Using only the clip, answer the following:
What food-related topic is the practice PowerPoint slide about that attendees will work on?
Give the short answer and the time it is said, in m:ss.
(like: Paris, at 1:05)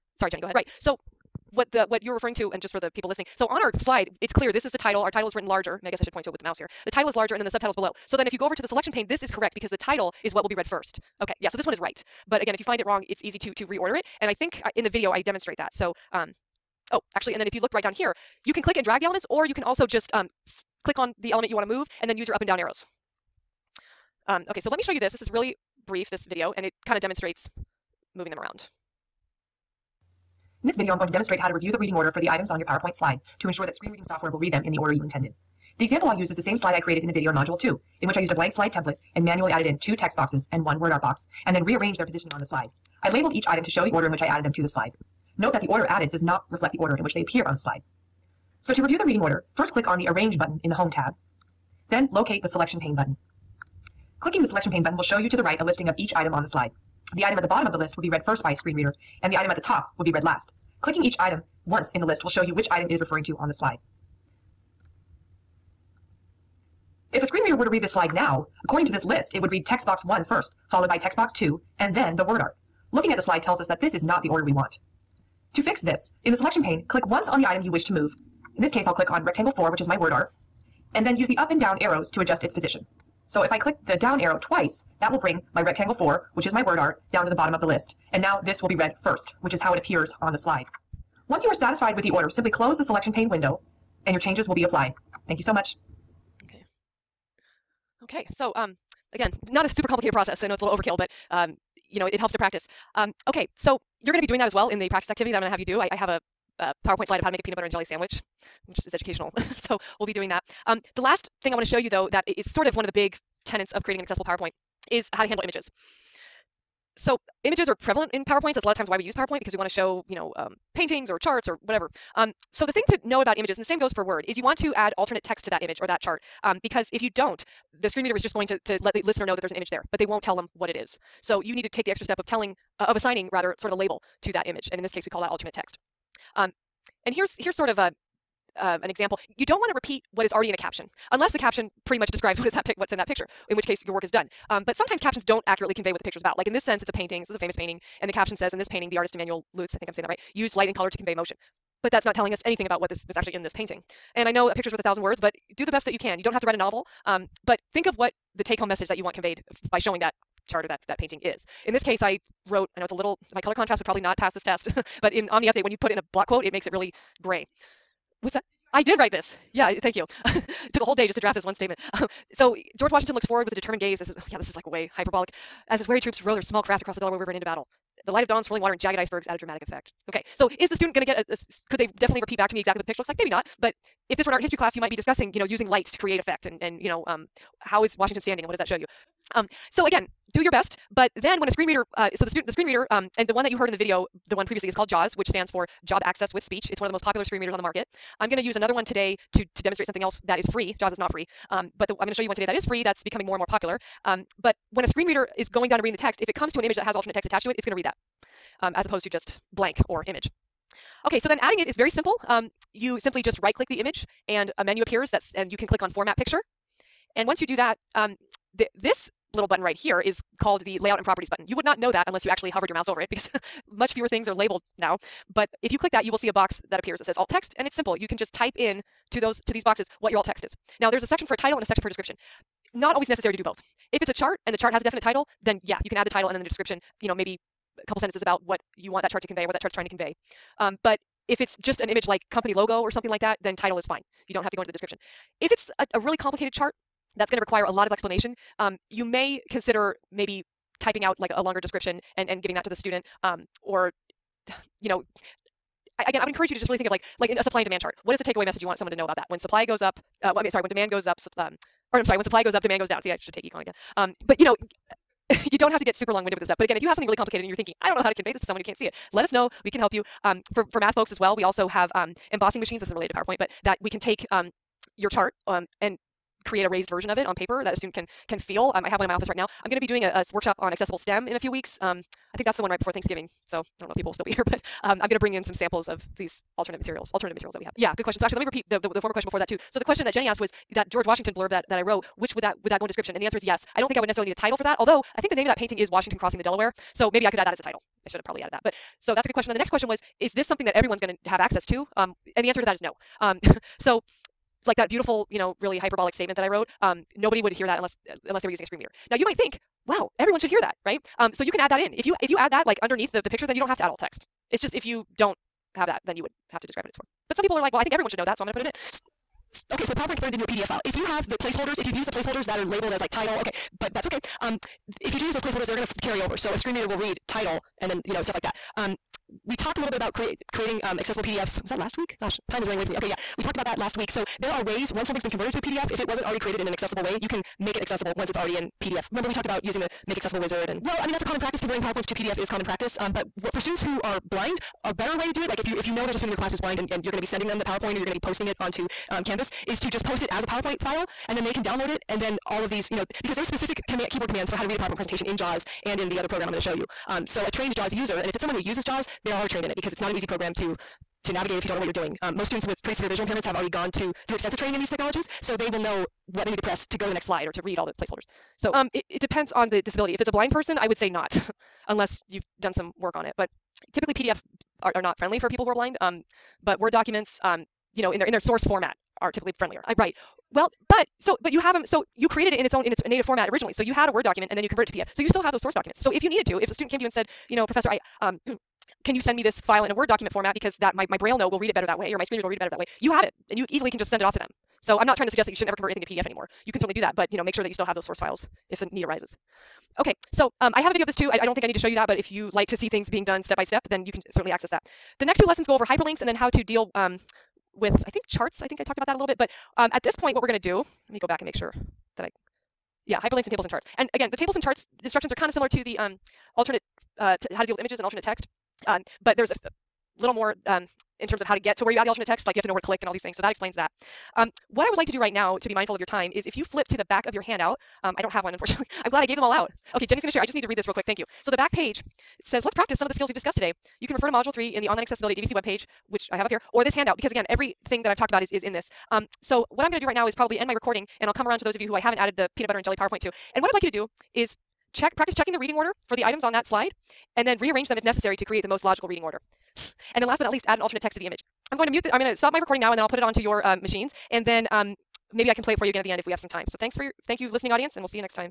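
Peanut butter and jelly sandwich, at 1:47.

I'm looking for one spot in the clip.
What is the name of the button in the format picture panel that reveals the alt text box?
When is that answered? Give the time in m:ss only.
3:40.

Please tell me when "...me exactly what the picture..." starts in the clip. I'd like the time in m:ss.
3:02.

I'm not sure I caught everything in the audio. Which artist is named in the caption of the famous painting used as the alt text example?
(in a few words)
Emanuel Leutze.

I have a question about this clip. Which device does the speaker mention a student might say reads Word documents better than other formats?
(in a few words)
BrailleNote.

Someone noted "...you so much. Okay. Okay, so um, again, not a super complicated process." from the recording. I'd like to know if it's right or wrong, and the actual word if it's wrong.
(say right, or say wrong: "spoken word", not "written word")
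right.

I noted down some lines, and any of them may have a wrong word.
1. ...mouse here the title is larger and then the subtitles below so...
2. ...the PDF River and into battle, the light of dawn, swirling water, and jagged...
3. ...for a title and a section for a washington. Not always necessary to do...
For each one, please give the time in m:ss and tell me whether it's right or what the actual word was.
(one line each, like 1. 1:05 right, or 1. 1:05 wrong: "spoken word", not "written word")
1. 0:06 right
2. 2:56 wrong: "Delaware", not "PDF"
3. 3:51 wrong: "description", not "washington".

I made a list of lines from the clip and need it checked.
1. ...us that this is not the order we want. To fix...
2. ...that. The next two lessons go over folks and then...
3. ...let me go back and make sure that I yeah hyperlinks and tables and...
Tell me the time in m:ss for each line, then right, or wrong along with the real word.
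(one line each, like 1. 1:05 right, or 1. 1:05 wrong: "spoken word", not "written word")
1. 1:13 right
2. 6:44 wrong: "hyperlinks", not "folks"
3. 6:51 right.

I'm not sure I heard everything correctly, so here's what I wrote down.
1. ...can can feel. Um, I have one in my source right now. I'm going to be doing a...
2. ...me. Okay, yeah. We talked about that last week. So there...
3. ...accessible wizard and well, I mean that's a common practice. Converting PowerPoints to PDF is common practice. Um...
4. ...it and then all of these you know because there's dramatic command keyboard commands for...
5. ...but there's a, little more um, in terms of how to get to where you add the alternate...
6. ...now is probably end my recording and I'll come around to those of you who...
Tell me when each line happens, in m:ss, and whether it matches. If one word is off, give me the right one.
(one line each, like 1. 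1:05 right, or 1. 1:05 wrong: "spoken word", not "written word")
1. 4:37 wrong: "office", not "source"
2. 5:32 right
3. 5:40 right
4. 5:51 wrong: "specific", not "dramatic"
5. 6:59 right
6. 7:20 right.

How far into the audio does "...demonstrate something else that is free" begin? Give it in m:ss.
3:19.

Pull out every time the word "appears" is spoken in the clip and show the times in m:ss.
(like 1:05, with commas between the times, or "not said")
0:47, 1:29, 3:34, 3:46.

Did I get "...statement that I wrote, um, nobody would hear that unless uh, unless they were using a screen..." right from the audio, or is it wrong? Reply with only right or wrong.
right.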